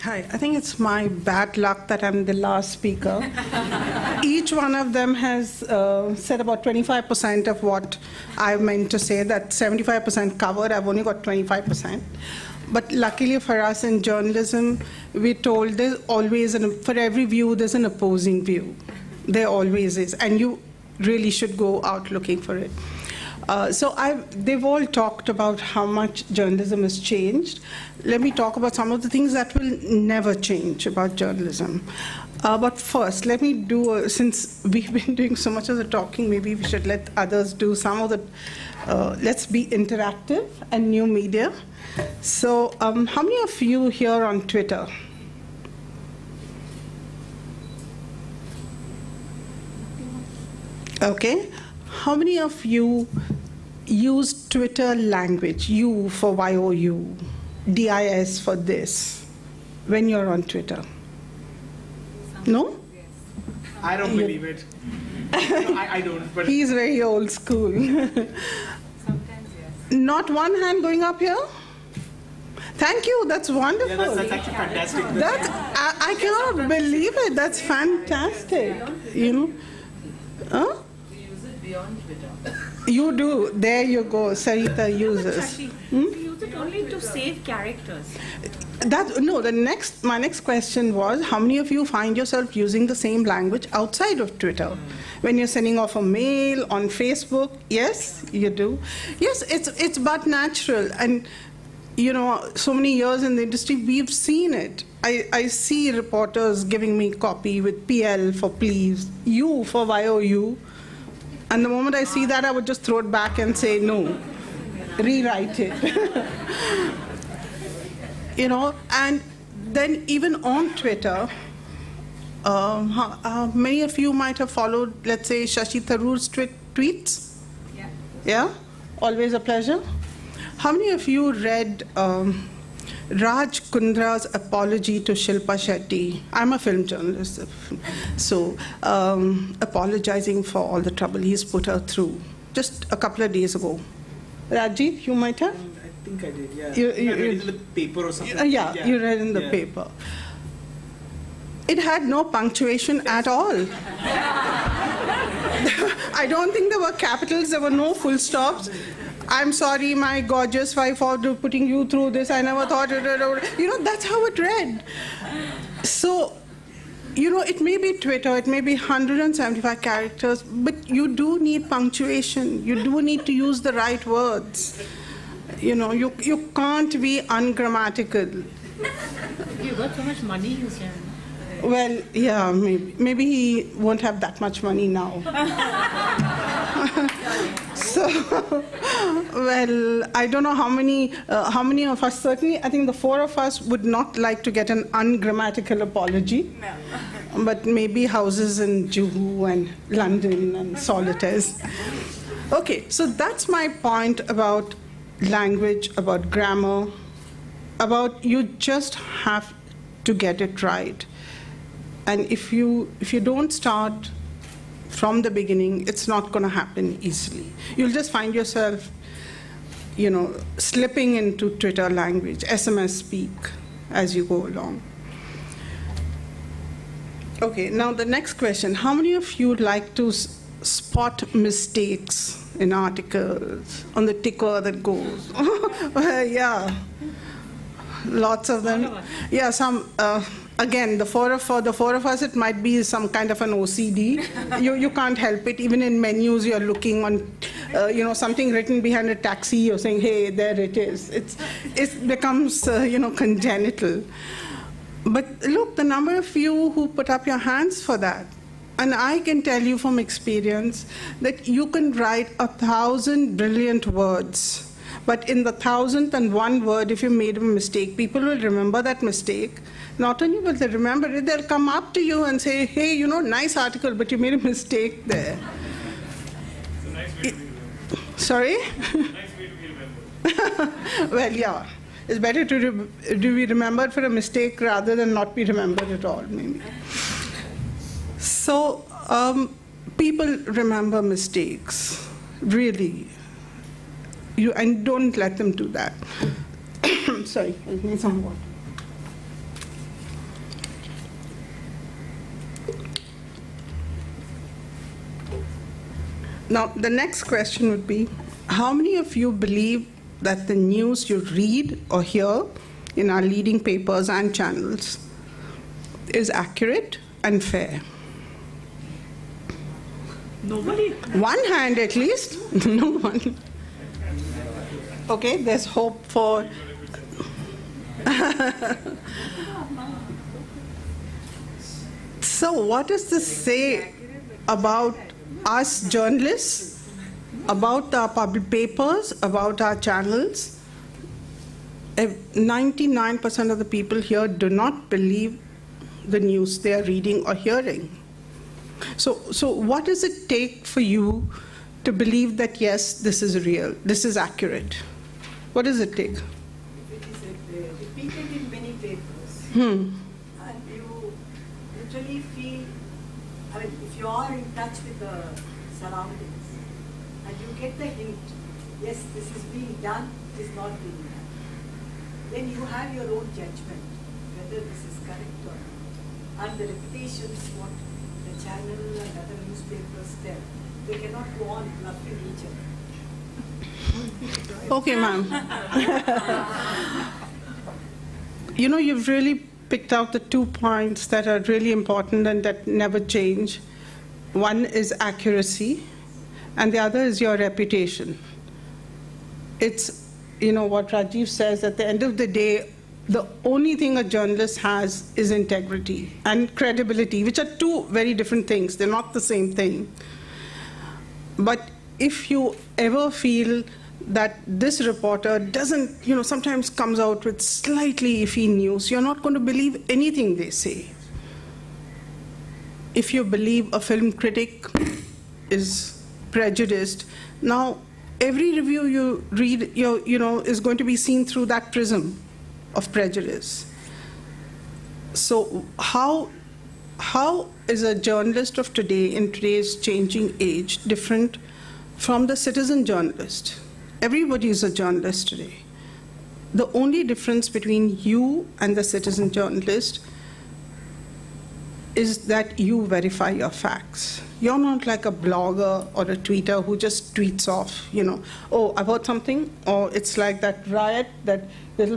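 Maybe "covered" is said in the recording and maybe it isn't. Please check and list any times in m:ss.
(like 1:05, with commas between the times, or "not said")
0:10.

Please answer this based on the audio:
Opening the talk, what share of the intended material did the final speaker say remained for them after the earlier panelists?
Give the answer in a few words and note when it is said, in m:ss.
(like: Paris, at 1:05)
25%, at 0:10.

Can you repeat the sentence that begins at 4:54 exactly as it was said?
You, and don't let them do that.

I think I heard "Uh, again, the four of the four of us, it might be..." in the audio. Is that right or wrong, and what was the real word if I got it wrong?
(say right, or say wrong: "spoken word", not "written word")
right.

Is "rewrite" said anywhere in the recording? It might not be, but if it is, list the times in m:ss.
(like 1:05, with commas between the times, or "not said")
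1:54.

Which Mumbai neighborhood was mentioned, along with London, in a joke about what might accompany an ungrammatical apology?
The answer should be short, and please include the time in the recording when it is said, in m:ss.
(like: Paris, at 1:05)
Juhu, at 3:18.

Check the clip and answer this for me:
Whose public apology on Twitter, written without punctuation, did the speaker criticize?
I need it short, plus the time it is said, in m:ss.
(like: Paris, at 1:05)
Raj Kundra, at 2:13.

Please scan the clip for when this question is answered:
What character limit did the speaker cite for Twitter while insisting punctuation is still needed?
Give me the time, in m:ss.
2:48.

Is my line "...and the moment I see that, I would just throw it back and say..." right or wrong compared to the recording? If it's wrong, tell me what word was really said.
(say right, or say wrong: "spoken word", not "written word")
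right.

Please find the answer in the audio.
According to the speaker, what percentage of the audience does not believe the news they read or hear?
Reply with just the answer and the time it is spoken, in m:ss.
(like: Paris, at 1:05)
99%, at 5:41.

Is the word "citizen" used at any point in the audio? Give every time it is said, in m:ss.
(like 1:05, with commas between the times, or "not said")
7:22, 7:28.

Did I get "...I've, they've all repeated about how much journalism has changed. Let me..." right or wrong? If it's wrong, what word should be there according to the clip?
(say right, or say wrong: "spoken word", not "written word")
wrong: "talked", not "repeated".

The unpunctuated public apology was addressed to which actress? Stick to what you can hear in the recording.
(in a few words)
Shilpa Shetty.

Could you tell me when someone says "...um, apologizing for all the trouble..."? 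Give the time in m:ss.
2:18.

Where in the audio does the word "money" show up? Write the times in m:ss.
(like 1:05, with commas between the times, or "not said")
3:00, 3:04.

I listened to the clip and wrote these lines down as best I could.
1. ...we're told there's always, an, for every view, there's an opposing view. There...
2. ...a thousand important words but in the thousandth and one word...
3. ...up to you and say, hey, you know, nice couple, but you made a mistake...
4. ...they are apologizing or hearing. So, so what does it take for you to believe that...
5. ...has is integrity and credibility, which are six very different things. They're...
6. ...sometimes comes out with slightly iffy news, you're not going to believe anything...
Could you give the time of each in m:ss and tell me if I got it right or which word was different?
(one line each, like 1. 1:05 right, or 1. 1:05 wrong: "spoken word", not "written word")
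1. 0:15 right
2. 4:22 wrong: "brilliant", not "important"
3. 4:31 wrong: "article", not "couple"
4. 5:46 wrong: "reading", not "apologizing"
5. 6:44 wrong: "two", not "six"
6. 6:56 right.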